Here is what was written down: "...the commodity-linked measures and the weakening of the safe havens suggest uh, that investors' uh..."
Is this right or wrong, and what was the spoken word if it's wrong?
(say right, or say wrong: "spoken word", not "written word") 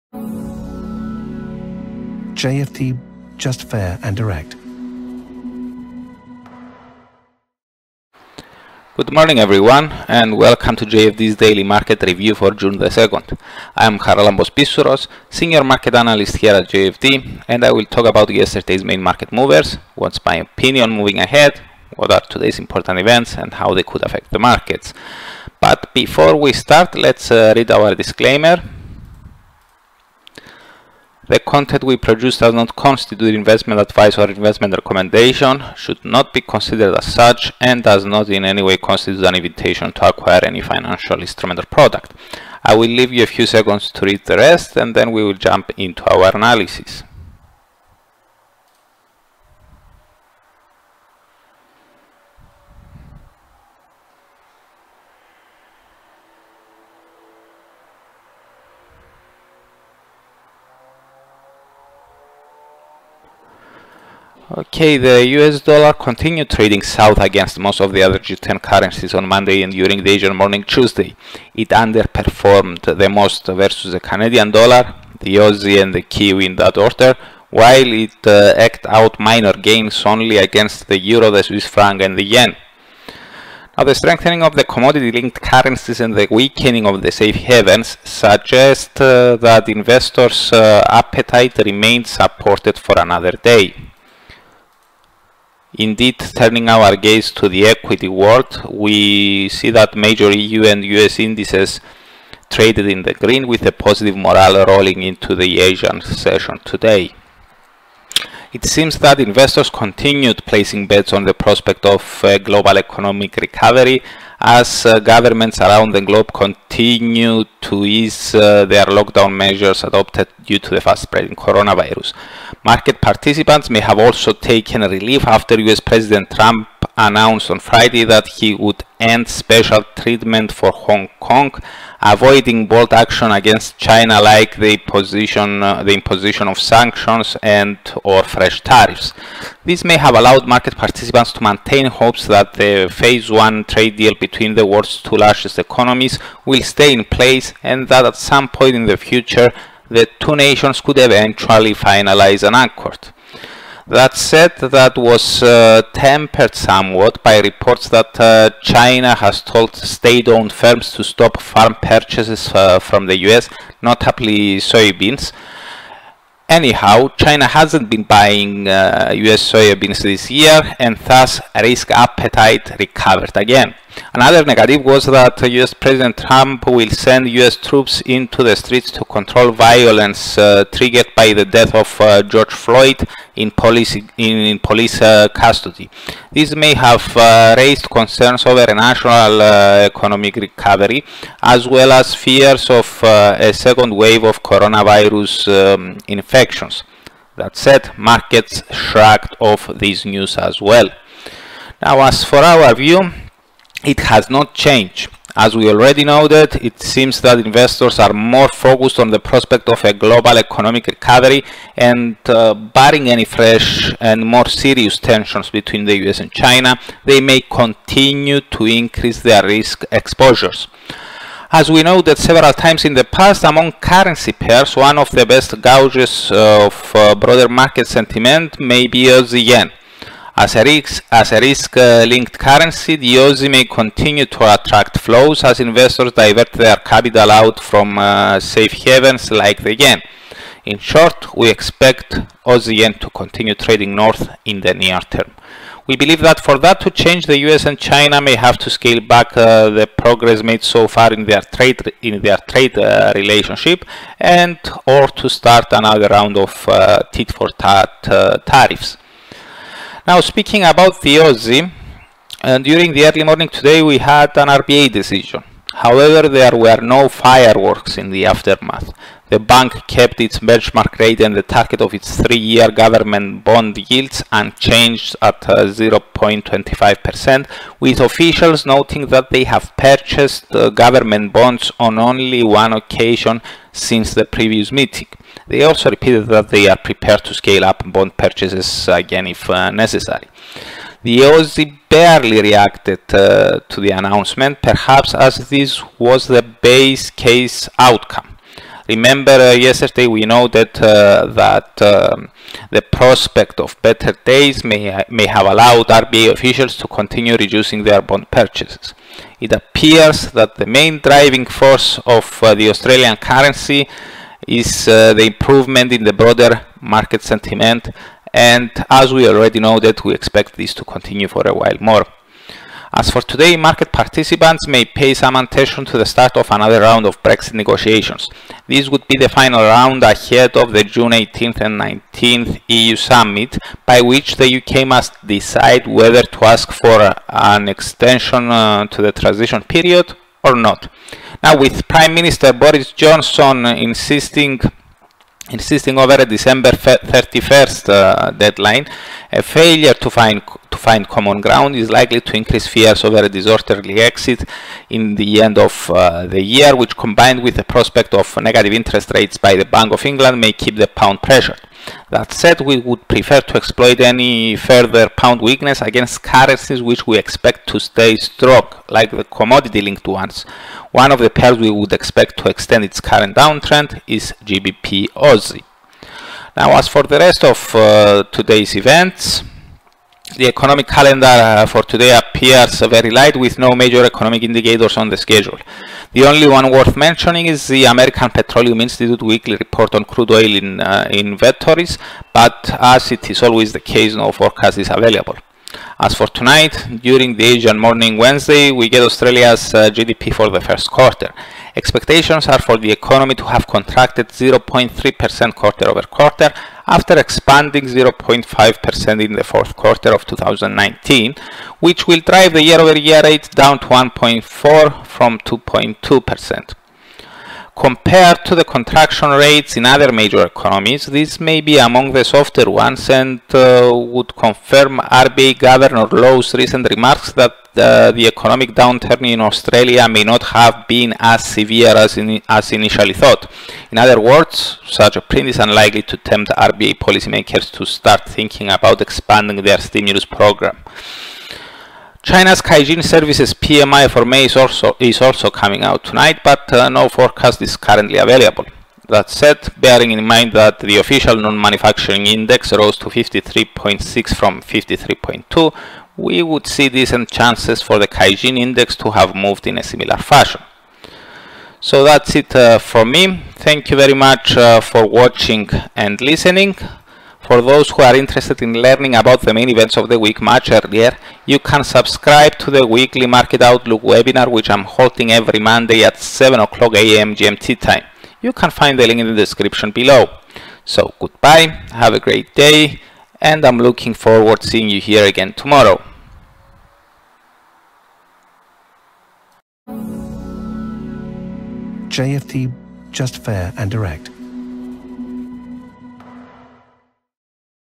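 wrong: "currencies", not "measures".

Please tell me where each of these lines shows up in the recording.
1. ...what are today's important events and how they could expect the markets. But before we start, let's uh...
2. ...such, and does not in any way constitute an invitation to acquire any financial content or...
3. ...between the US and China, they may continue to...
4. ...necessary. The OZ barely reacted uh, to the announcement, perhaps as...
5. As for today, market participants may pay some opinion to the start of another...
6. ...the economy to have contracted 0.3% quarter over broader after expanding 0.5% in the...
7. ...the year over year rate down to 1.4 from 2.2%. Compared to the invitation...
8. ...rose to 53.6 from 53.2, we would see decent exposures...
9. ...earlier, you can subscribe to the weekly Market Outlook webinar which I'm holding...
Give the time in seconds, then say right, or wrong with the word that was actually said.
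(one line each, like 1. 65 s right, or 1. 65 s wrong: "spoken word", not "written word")
1. 21 s wrong: "affect", not "expect"
2. 37 s wrong: "instrument", not "content"
3. 215 s right
4. 289 s right
5. 322 s wrong: "attention", not "opinion"
6. 402 s wrong: "quarter", not "broader"
7. 412 s wrong: "contraction", not "invitation"
8. 452 s wrong: "chances", not "exposures"
9. 470 s right.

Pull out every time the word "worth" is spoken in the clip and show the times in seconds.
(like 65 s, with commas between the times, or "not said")
386 s.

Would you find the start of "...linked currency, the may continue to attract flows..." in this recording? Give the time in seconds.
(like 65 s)
232 s.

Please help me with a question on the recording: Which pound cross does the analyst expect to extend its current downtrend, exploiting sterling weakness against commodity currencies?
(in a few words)
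GBP Aussie.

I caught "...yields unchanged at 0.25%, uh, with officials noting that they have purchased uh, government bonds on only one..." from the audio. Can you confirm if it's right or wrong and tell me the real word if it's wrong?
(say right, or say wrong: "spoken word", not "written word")
right.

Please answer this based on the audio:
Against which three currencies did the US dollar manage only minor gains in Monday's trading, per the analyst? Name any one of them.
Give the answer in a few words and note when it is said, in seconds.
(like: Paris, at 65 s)
Swiss franc, at 81 s.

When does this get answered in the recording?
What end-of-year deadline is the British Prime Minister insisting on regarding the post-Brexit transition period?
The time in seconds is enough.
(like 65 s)
346 s.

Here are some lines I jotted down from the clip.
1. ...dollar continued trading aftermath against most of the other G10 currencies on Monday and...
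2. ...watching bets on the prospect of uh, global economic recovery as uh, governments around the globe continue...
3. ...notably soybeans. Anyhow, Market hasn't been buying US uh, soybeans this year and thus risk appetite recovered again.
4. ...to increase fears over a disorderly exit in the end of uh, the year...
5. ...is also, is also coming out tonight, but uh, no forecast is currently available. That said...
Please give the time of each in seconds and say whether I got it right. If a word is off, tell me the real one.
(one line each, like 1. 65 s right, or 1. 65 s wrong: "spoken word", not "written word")
1. 65 s wrong: "south", not "aftermath"
2. 110 s wrong: "placing", not "watching"
3. 163 s wrong: "China", not "Market"
4. 352 s right
5. 444 s right.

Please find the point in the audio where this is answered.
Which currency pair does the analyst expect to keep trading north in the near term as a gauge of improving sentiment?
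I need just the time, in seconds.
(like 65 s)
242 s.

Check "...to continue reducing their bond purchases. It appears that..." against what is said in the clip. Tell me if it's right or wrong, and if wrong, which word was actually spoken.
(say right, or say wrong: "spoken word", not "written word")
right.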